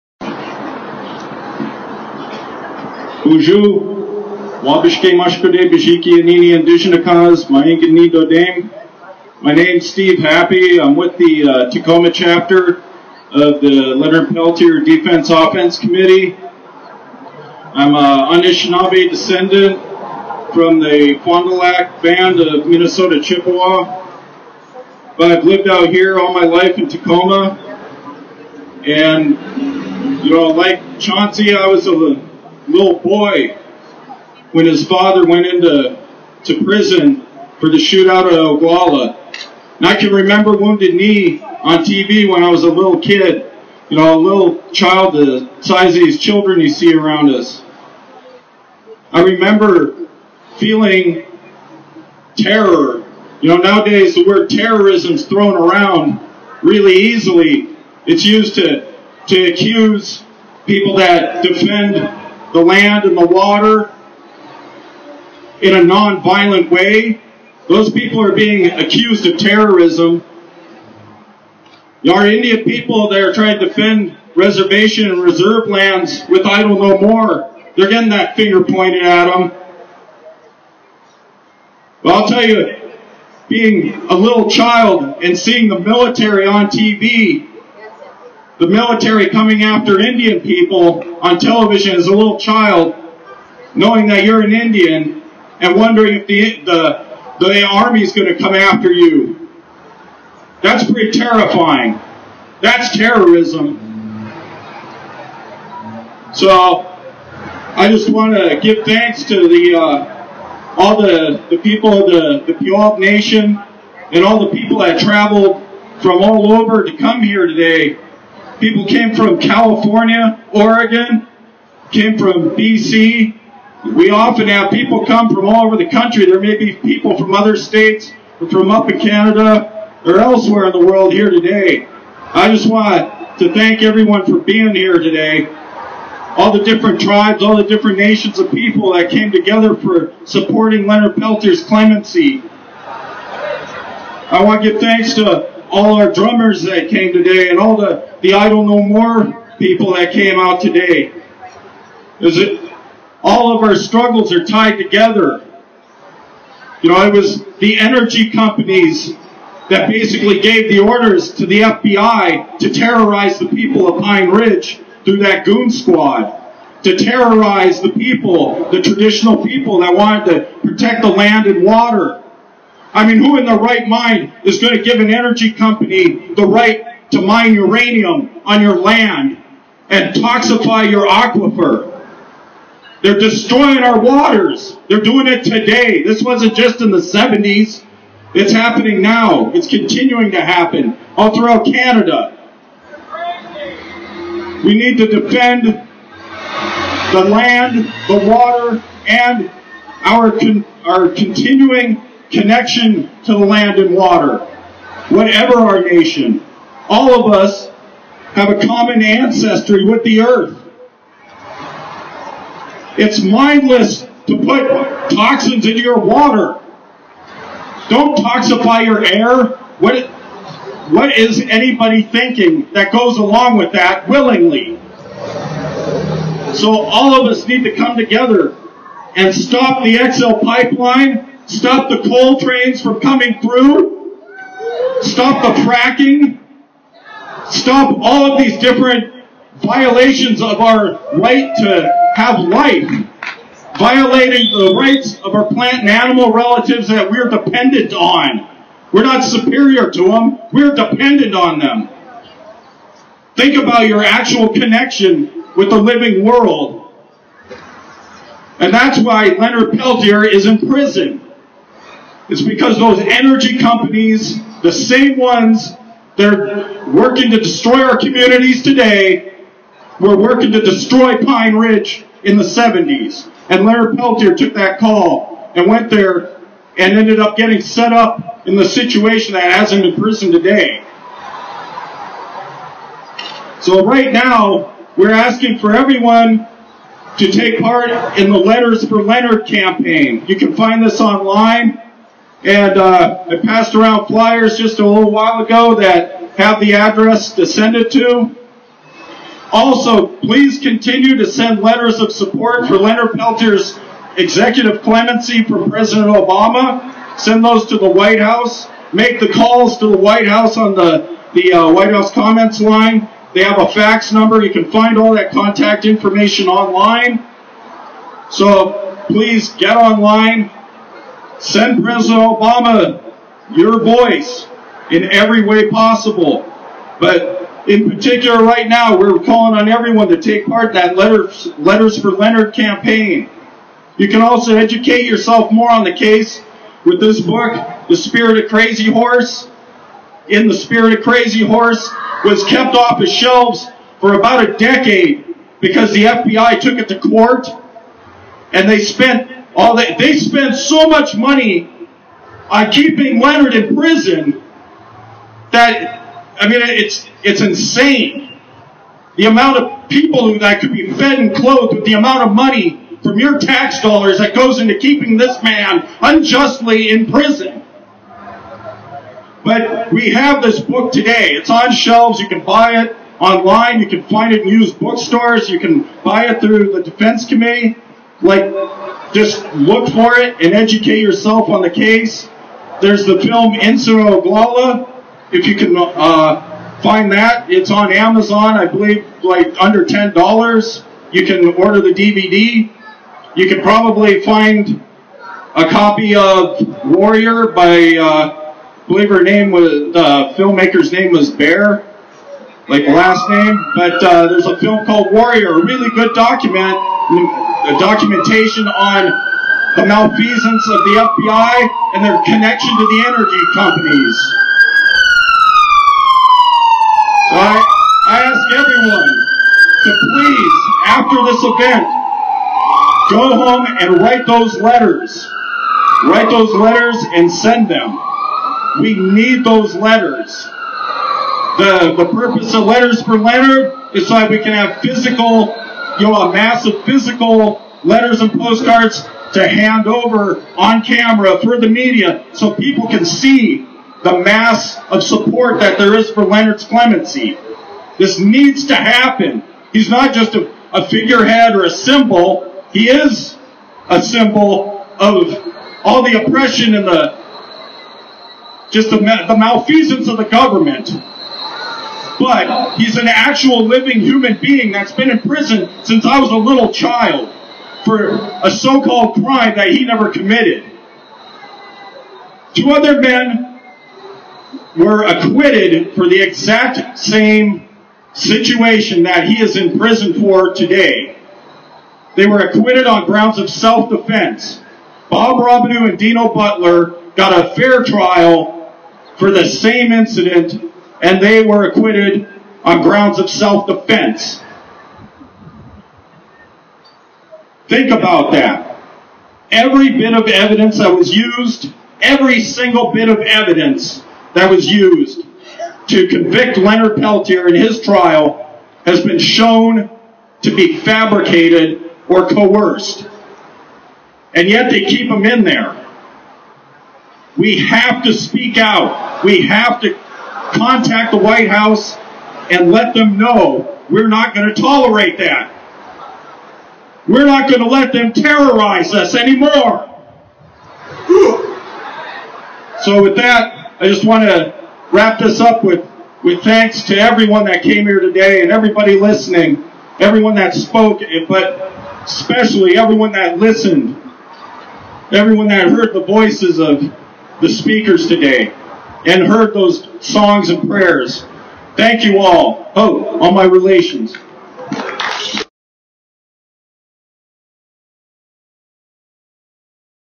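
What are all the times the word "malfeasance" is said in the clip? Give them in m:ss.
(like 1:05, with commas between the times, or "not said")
6:49, 7:39.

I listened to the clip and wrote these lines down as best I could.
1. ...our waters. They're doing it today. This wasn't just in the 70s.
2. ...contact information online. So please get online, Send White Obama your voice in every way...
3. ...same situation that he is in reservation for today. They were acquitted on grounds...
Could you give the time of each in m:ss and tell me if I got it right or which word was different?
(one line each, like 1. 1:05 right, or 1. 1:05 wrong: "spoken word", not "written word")
1. 3:03 right
2. 5:15 wrong: "President", not "White"
3. 7:56 wrong: "prison", not "reservation".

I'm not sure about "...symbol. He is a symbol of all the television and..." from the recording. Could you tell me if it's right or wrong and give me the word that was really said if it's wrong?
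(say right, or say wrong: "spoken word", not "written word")
wrong: "oppression", not "television".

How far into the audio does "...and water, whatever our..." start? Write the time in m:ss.
3:23.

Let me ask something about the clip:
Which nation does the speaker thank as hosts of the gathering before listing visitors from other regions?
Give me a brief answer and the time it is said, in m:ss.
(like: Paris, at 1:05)
Puyallup Nation, at 1:52.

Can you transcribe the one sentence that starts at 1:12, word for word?
Our Indian people, they're trying to defend reservation and reserve lands with idle no more.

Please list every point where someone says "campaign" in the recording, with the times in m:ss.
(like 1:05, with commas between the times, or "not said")
4:49, 5:32.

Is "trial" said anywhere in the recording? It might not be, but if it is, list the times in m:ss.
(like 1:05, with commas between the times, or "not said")
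8:07, 8:27.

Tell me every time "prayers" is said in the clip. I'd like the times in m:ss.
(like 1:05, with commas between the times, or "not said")
9:10.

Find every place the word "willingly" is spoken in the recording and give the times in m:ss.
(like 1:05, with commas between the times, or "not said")
3:44.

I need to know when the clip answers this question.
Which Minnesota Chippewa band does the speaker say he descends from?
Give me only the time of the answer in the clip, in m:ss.
0:21.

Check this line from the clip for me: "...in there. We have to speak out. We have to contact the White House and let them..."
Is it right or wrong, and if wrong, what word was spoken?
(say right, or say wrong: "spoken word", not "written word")
right.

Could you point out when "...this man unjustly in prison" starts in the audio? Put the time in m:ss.
6:05.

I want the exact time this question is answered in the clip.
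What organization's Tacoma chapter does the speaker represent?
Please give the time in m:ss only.
0:13.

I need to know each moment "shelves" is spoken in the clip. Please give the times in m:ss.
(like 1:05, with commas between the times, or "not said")
5:43, 6:11.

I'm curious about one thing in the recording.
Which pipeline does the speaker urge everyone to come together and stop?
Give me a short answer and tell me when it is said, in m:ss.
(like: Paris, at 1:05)
XL pipeline, at 3:49.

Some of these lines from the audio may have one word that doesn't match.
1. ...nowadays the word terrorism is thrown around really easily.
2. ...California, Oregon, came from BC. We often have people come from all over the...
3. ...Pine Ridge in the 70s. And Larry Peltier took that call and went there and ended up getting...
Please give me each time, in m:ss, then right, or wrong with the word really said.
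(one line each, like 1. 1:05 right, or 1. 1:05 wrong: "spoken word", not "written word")
1. 0:53 right
2. 1:59 right
3. 4:31 right.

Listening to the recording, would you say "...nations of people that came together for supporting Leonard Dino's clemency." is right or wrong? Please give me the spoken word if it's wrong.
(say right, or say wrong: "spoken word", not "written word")
wrong: "Peltier", not "Dino".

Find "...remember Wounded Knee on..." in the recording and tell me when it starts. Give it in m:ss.
0:40.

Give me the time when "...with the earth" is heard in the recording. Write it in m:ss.
3:29.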